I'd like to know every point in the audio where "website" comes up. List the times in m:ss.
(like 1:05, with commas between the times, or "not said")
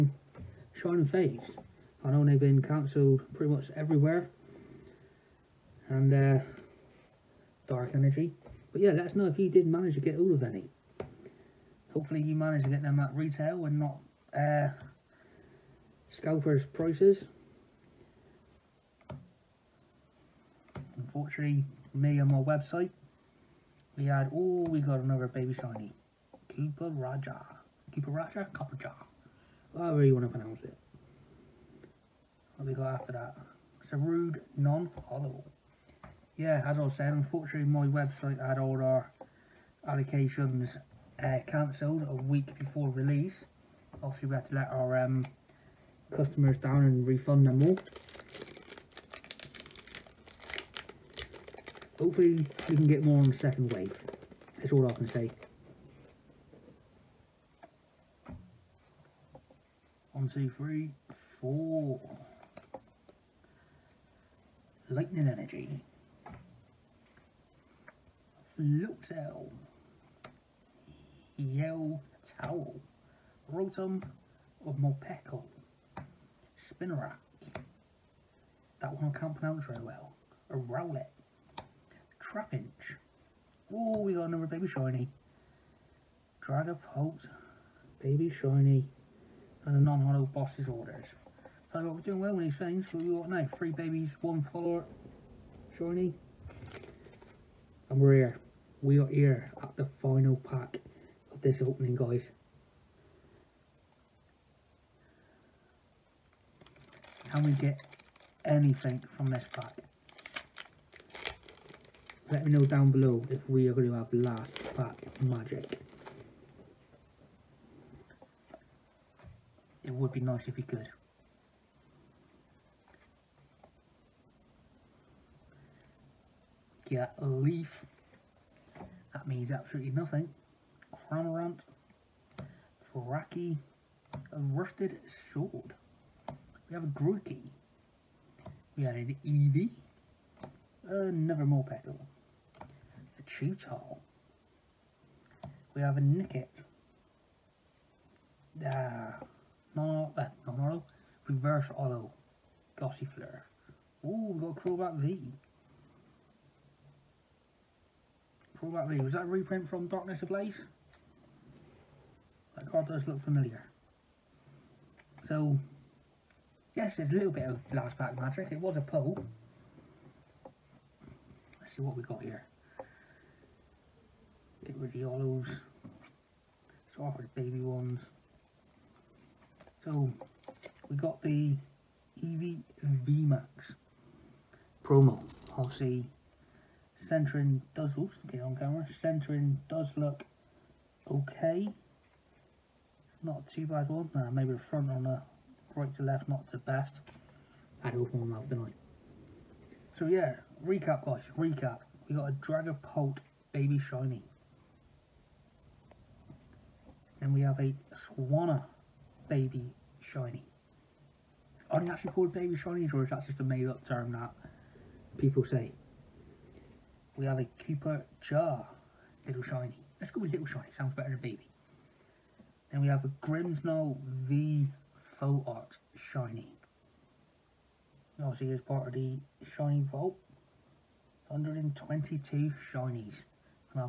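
0:22, 0:37.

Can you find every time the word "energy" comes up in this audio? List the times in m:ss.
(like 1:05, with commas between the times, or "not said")
0:07, 1:05.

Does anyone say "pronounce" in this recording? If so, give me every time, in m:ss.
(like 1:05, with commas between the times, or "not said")
0:30, 1:19.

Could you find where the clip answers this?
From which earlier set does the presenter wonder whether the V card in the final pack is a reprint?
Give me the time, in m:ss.
2:39.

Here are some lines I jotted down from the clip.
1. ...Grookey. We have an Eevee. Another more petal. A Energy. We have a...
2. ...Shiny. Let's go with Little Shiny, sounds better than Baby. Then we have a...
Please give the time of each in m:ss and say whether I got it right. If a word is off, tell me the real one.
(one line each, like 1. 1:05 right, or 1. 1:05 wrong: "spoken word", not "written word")
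1. 2:16 wrong: "Cheetar", not "Energy"
2. 3:39 right.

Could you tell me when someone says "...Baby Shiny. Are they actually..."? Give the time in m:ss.
3:29.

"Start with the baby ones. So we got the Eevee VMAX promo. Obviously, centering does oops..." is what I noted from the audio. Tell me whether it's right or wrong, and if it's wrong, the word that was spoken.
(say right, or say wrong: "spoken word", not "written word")
right.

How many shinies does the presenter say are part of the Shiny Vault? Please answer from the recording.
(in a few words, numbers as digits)
122.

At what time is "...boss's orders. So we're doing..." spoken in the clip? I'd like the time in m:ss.
1:30.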